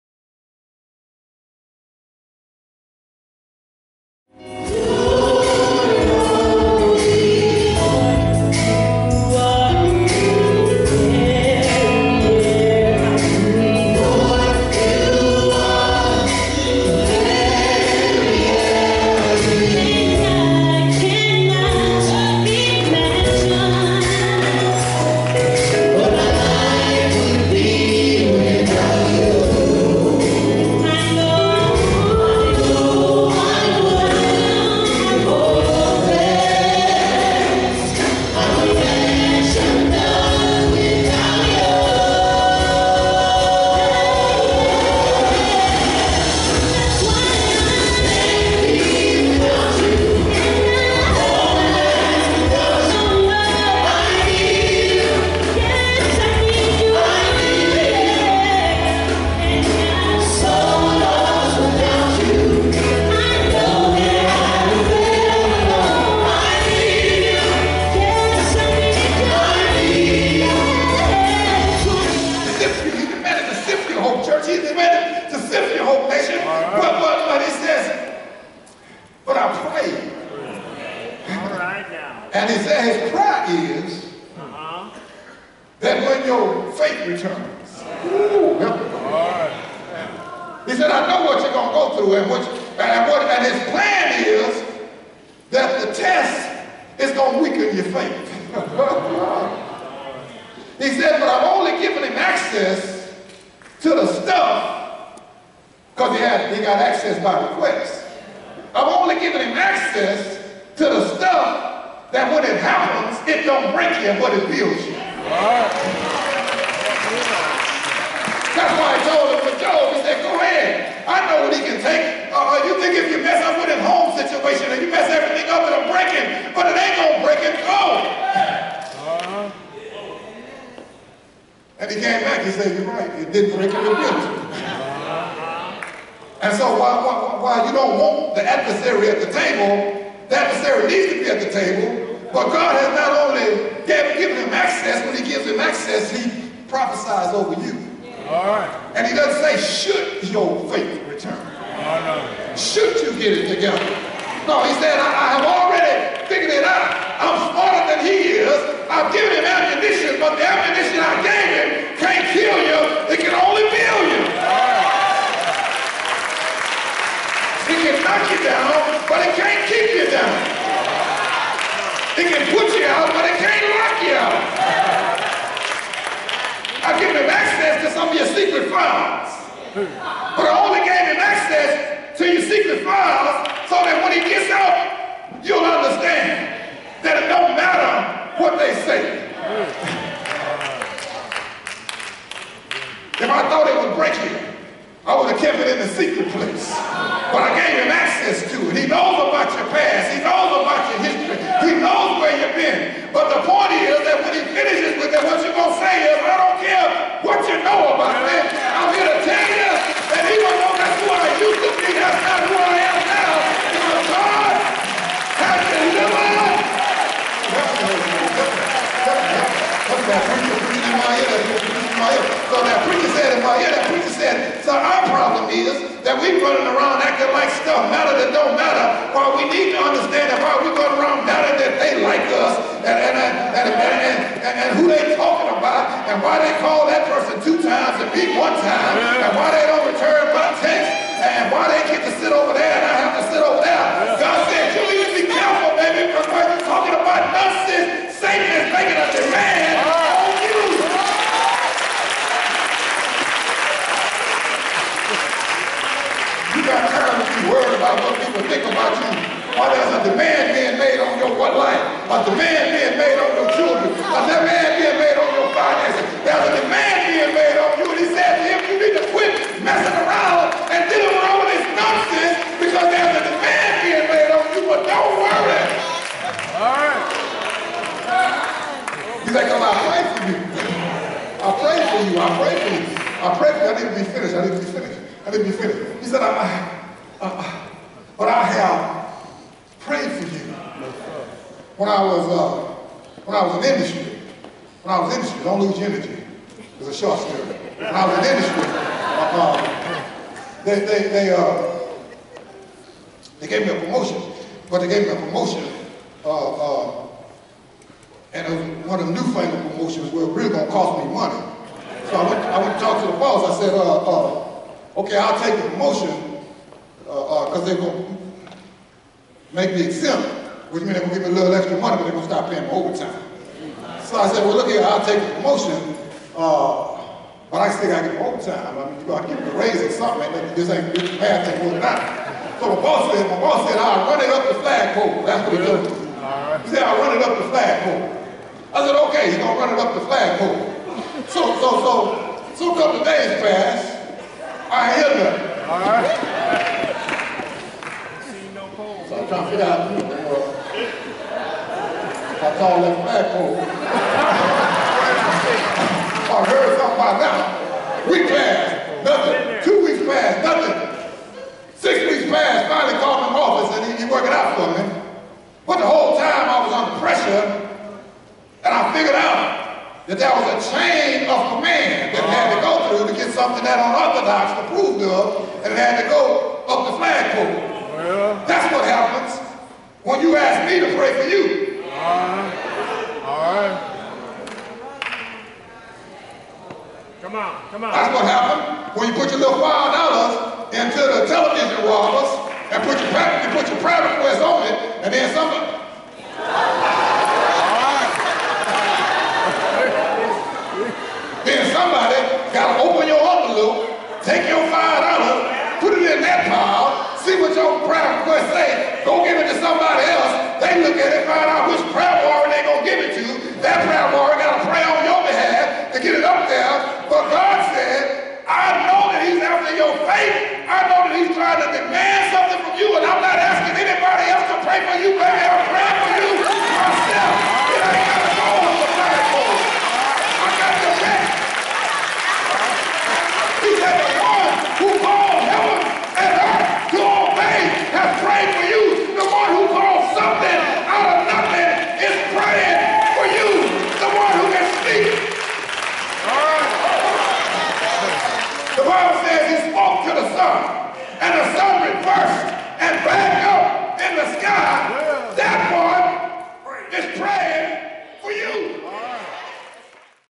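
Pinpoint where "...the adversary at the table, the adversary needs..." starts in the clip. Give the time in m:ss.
2:18.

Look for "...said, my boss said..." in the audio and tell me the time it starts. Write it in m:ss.
5:33.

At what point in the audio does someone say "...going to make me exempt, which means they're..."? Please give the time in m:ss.
5:17.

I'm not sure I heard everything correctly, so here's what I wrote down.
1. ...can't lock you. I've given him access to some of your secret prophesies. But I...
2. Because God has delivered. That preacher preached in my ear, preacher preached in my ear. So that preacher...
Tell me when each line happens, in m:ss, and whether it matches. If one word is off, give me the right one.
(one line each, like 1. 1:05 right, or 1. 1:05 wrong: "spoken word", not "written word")
1. 2:53 wrong: "files", not "prophesies"
2. 3:33 right.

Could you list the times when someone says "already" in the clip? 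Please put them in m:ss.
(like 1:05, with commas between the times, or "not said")
2:35.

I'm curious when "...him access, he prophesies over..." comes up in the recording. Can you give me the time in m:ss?
2:25.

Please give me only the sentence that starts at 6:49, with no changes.
Go give it to somebody else.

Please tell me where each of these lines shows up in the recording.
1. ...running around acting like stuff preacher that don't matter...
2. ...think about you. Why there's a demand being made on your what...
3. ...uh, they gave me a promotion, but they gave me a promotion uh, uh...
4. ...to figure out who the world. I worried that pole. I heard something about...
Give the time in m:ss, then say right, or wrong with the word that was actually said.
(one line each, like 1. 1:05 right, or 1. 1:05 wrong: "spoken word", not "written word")
1. 3:46 wrong: "matter", not "preacher"
2. 4:18 right
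3. 5:01 right
4. 5:49 wrong: "called", not "worried".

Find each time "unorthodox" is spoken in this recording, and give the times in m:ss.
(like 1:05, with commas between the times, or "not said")
6:13.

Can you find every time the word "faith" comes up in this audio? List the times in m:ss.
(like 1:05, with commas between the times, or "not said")
1:26, 1:37, 2:30.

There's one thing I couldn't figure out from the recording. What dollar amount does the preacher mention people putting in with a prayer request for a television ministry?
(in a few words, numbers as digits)
$5.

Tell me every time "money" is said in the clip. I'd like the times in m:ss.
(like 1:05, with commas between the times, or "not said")
5:11, 5:21.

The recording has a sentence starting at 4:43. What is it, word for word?
I prayed need to be finished, I need to be finished, I need to be finished.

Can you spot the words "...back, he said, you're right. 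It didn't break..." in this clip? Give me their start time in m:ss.
2:12.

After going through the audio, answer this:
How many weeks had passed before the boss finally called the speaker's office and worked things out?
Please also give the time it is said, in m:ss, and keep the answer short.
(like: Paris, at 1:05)
6, at 6:01.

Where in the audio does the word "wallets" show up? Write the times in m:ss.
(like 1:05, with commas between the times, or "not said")
6:31.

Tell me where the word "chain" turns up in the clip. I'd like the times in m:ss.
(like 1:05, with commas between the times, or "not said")
6:10.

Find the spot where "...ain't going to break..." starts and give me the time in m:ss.
2:06.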